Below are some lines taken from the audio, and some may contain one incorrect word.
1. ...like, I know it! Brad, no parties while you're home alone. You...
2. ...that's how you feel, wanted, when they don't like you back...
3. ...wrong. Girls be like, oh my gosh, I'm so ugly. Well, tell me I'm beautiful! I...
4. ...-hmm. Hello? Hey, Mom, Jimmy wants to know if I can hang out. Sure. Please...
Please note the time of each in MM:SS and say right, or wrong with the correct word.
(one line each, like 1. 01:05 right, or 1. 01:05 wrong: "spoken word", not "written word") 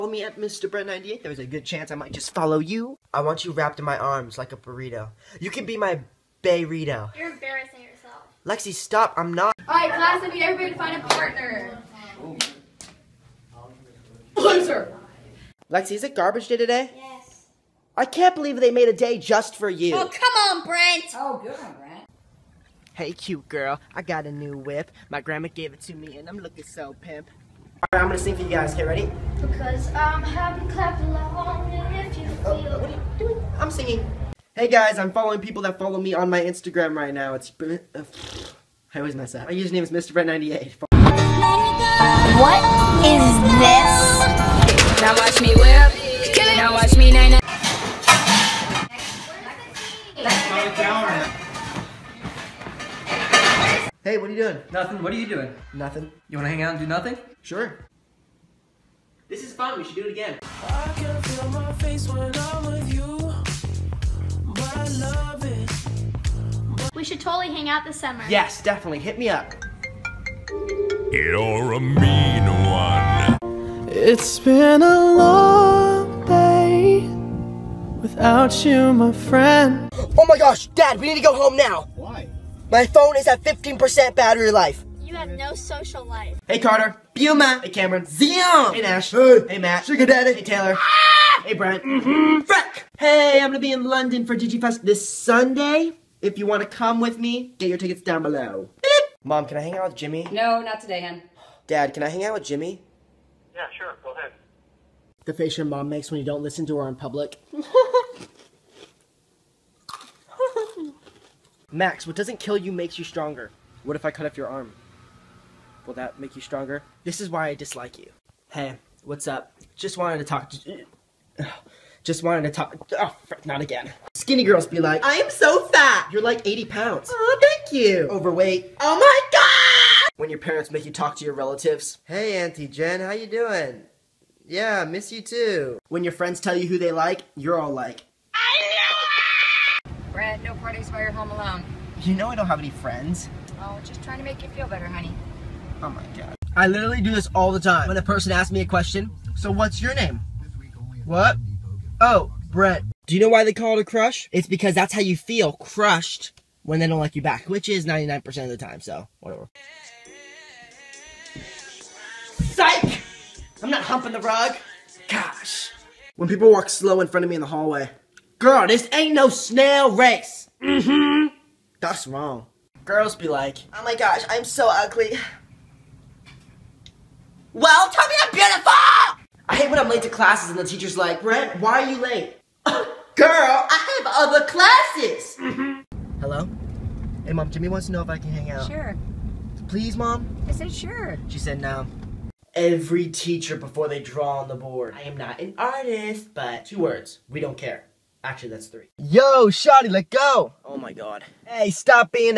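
1. 02:17 right
2. 02:34 wrong: "crushed", not "wanted"
3. 02:52 right
4. 03:05 right.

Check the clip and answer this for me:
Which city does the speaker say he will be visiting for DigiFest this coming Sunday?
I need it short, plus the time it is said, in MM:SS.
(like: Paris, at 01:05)
London, at 01:33.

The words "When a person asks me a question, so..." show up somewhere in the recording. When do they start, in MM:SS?
02:27.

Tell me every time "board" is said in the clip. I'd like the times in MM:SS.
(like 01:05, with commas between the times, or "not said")
03:14.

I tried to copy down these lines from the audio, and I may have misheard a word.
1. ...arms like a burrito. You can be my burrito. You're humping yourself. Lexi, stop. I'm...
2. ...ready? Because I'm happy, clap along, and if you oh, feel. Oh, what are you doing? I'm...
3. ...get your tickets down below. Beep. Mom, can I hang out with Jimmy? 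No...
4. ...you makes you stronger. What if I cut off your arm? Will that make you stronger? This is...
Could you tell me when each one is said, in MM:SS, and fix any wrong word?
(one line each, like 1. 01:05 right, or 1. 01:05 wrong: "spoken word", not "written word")
1. 00:03 wrong: "embarrassing", not "humping"
2. 00:28 right
3. 01:37 right
4. 01:52 right.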